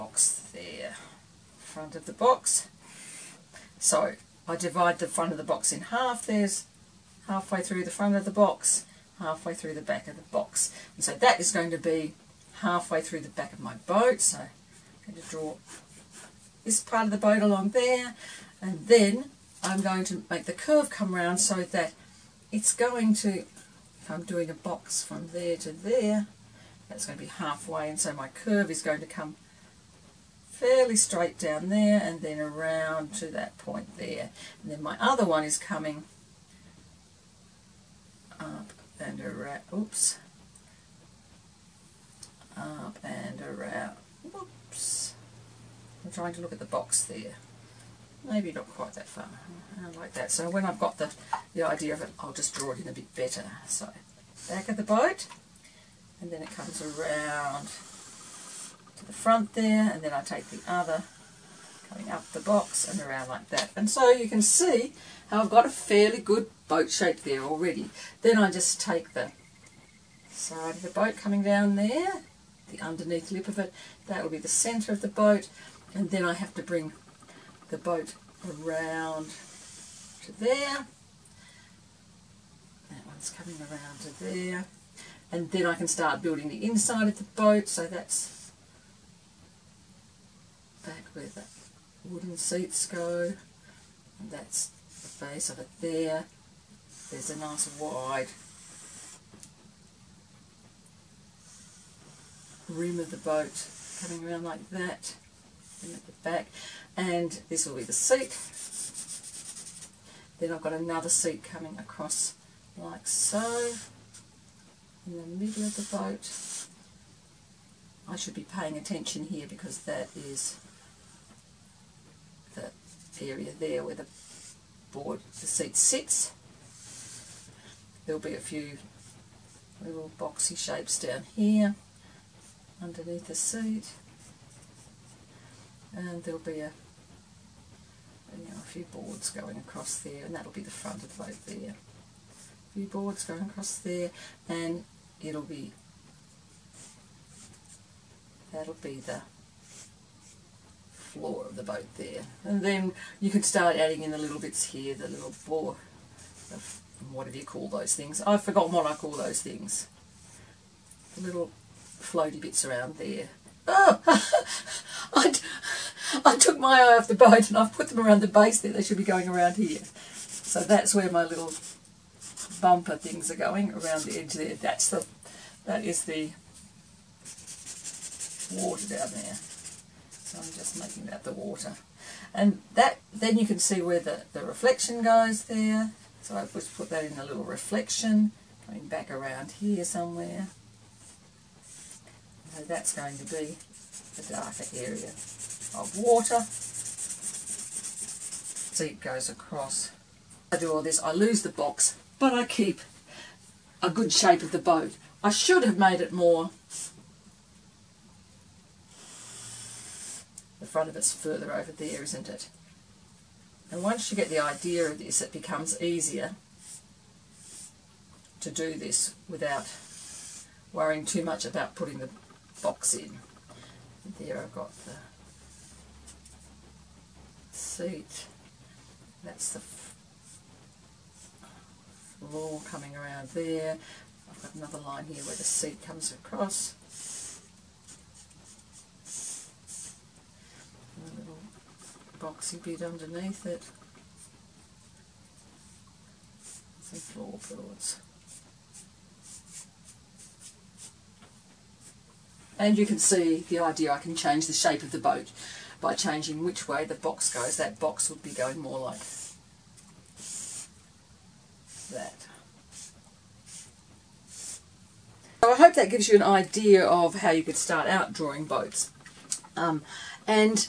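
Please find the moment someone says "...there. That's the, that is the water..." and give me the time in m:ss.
2:54.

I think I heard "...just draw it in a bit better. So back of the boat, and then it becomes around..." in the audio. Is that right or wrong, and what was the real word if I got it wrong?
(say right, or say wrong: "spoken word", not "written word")
wrong: "comes", not "becomes".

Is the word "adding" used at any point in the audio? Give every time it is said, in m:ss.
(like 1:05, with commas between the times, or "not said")
2:33.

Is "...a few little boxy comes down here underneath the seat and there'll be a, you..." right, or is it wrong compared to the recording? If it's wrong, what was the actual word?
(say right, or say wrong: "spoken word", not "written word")
wrong: "shapes", not "comes".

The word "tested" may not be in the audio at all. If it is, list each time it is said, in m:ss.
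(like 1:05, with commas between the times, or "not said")
not said.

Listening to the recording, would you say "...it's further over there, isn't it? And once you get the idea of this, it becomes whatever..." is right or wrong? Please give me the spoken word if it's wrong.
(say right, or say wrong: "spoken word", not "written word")
wrong: "easier", not "whatever".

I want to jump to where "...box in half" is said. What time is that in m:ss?
0:05.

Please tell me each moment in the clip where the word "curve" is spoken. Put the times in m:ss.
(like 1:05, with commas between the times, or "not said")
0:20, 0:28.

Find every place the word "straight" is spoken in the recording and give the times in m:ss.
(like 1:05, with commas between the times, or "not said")
0:30.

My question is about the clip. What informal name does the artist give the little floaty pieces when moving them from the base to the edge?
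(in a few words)
bumper things.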